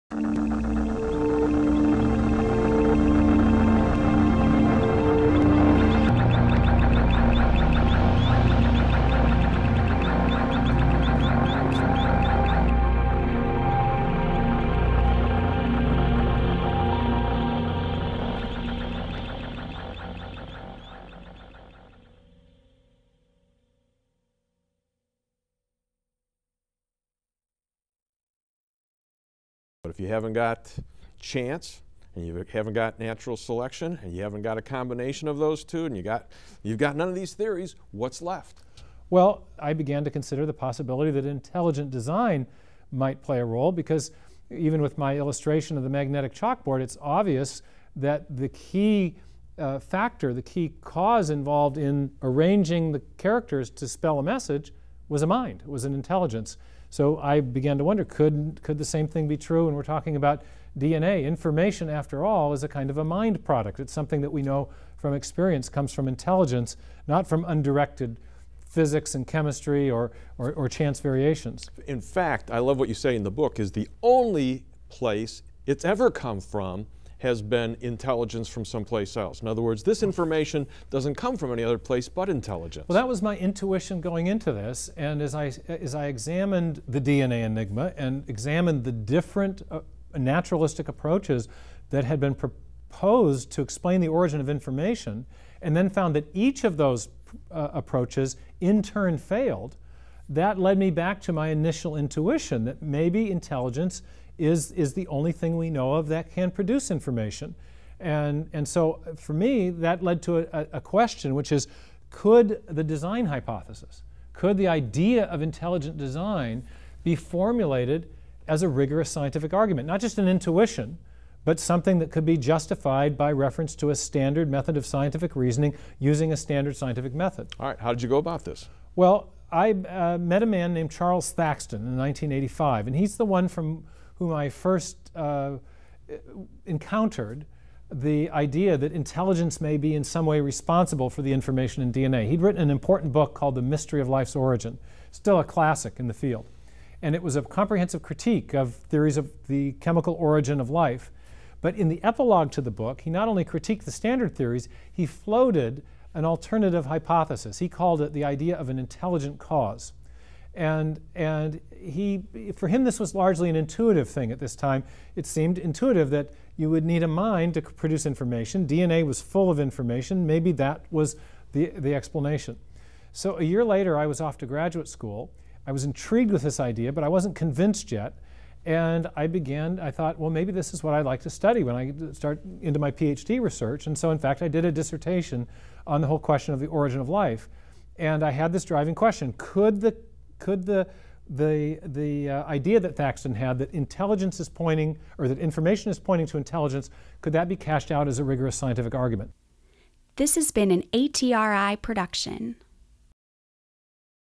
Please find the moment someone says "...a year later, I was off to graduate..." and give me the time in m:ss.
2:53.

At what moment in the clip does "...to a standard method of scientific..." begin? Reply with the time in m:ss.
2:03.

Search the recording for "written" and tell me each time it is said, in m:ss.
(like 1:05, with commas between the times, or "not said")
2:22.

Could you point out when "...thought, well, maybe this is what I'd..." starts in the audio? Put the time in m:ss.
2:59.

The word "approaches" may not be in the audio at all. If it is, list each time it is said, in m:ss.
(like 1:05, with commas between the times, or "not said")
1:30, 1:37.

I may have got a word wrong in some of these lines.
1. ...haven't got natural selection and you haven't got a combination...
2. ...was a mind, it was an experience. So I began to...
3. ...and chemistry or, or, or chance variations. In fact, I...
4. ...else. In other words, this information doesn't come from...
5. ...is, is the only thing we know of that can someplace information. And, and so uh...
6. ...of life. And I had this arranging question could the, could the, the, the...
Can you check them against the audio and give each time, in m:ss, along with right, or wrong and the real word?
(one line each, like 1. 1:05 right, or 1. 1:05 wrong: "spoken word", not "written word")
1. 0:32 right
2. 0:55 wrong: "intelligence", not "experience"
3. 1:09 right
4. 1:19 right
5. 1:44 wrong: "produce", not "someplace"
6. 3:06 wrong: "driving", not "arranging".